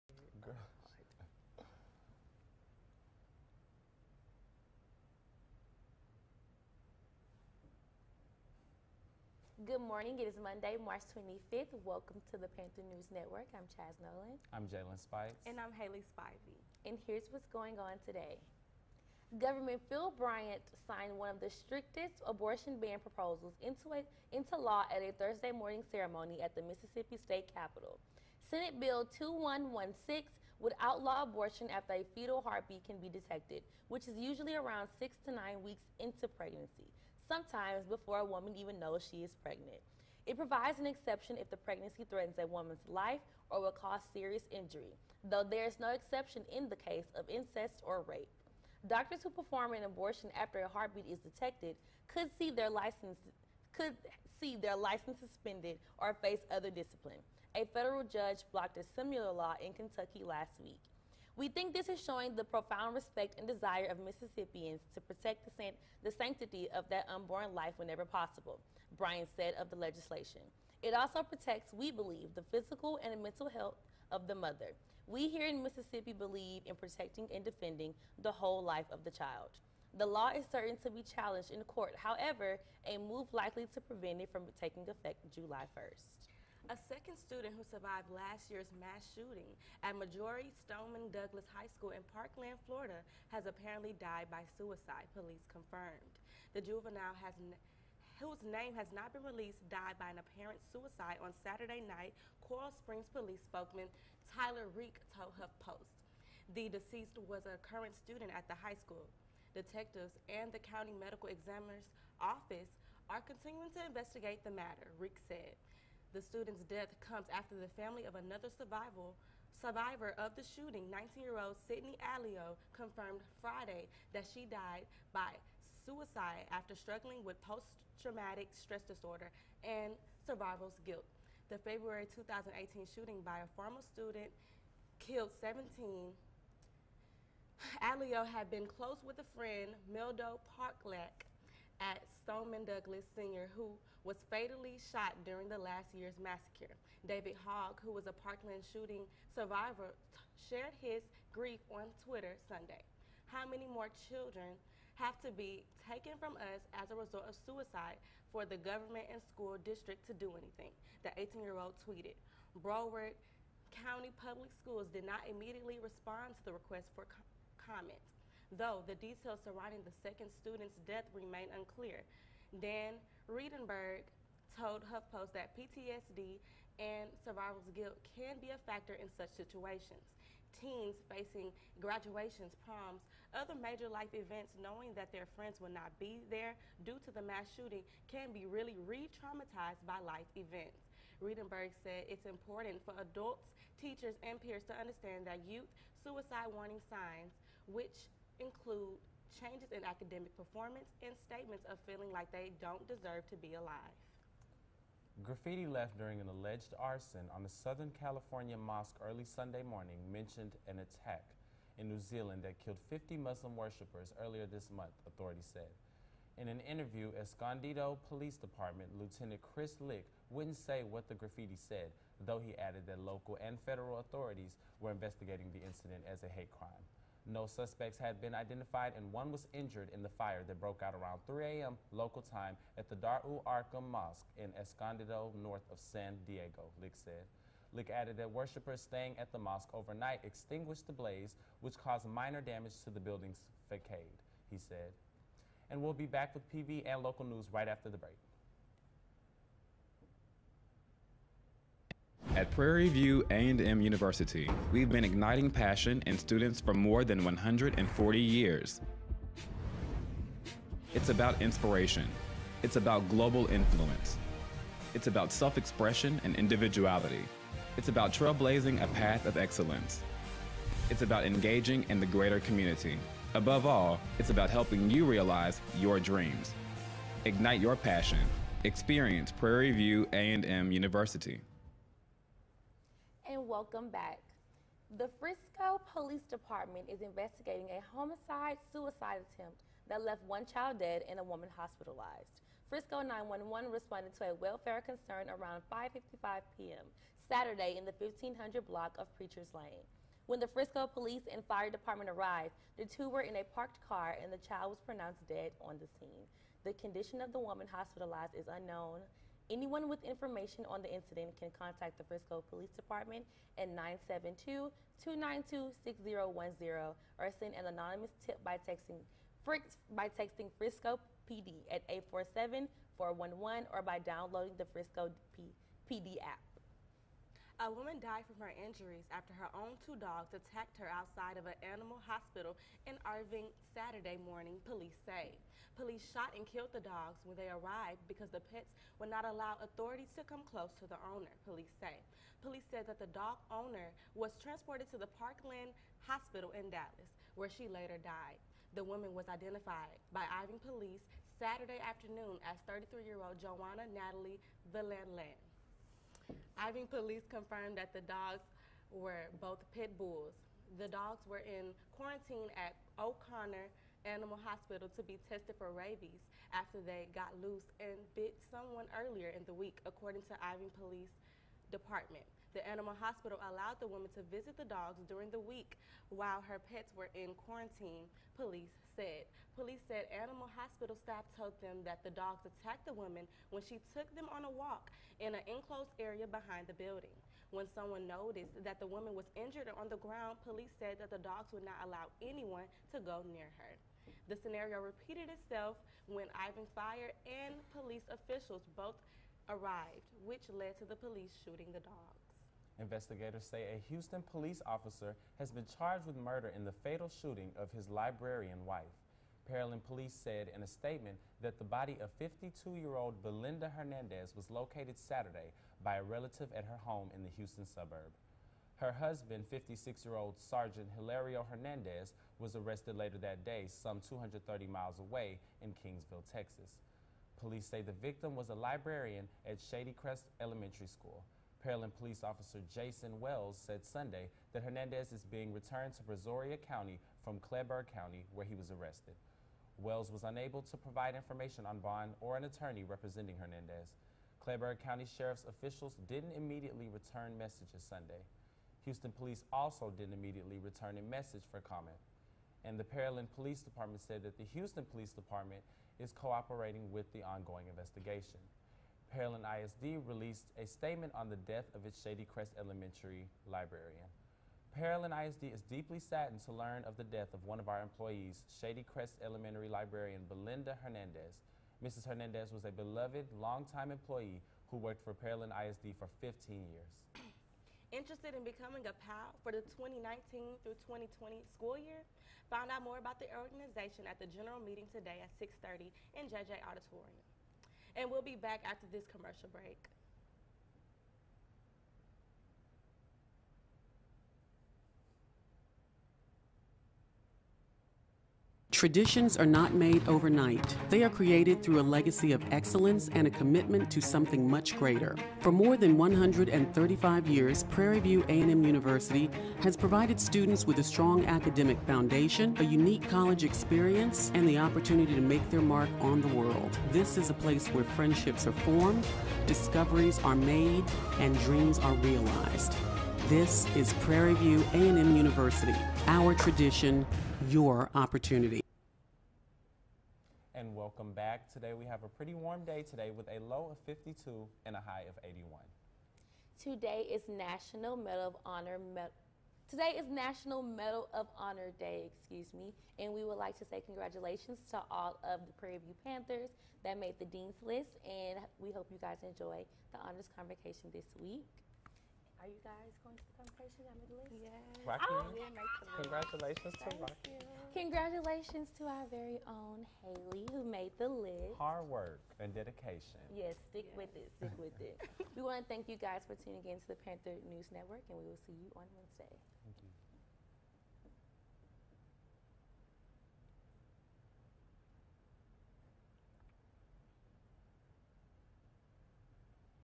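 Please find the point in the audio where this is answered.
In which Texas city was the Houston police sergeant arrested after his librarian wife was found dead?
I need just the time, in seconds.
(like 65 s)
425 s.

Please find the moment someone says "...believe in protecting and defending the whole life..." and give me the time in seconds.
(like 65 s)
76 s.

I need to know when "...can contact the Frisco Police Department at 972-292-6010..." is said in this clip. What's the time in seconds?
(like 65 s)
311 s.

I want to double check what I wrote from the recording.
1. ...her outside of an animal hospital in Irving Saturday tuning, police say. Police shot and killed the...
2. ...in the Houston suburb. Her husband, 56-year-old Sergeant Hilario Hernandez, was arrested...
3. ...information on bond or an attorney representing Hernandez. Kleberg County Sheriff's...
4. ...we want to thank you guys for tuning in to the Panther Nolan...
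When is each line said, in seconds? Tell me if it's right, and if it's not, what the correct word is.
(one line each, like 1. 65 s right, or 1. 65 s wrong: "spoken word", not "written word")
1. 330 s wrong: "morning", not "tuning"
2. 417 s right
3. 441 s right
4. 565 s wrong: "News", not "Nolan".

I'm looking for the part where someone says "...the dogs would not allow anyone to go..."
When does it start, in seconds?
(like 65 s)
391 s.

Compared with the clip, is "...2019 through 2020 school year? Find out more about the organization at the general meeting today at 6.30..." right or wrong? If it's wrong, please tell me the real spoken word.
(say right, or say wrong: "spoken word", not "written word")
right.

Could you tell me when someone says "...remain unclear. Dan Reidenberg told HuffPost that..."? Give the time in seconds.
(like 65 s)
171 s.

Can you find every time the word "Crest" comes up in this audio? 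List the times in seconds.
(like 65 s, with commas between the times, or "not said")
429 s, 462 s, 468 s.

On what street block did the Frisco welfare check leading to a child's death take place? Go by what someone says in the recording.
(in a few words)
Preacher's Lane.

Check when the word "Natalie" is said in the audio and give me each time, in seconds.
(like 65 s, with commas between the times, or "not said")
353 s.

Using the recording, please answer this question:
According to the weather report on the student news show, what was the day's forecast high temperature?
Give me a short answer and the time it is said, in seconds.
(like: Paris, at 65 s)
81, at 535 s.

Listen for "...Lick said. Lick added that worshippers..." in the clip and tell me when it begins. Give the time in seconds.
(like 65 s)
236 s.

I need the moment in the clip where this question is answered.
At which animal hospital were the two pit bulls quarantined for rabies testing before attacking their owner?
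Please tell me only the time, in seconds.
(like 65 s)
362 s.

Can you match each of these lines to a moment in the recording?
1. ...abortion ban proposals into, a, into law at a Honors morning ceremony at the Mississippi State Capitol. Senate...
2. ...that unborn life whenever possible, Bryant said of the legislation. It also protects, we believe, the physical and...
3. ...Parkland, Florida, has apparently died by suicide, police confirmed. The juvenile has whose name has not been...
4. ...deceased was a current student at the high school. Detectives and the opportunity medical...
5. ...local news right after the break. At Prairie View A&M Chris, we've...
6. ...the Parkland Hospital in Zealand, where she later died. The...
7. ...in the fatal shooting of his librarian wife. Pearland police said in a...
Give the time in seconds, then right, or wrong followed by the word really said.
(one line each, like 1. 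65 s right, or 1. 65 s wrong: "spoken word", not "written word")
1. 22 s wrong: "Thursday", not "Honors"
2. 66 s right
3. 92 s right
4. 106 s wrong: "county", not "opportunity"
5. 247 s wrong: "University", not "Chris"
6. 344 s wrong: "Dallas", not "Zealand"
7. 406 s right.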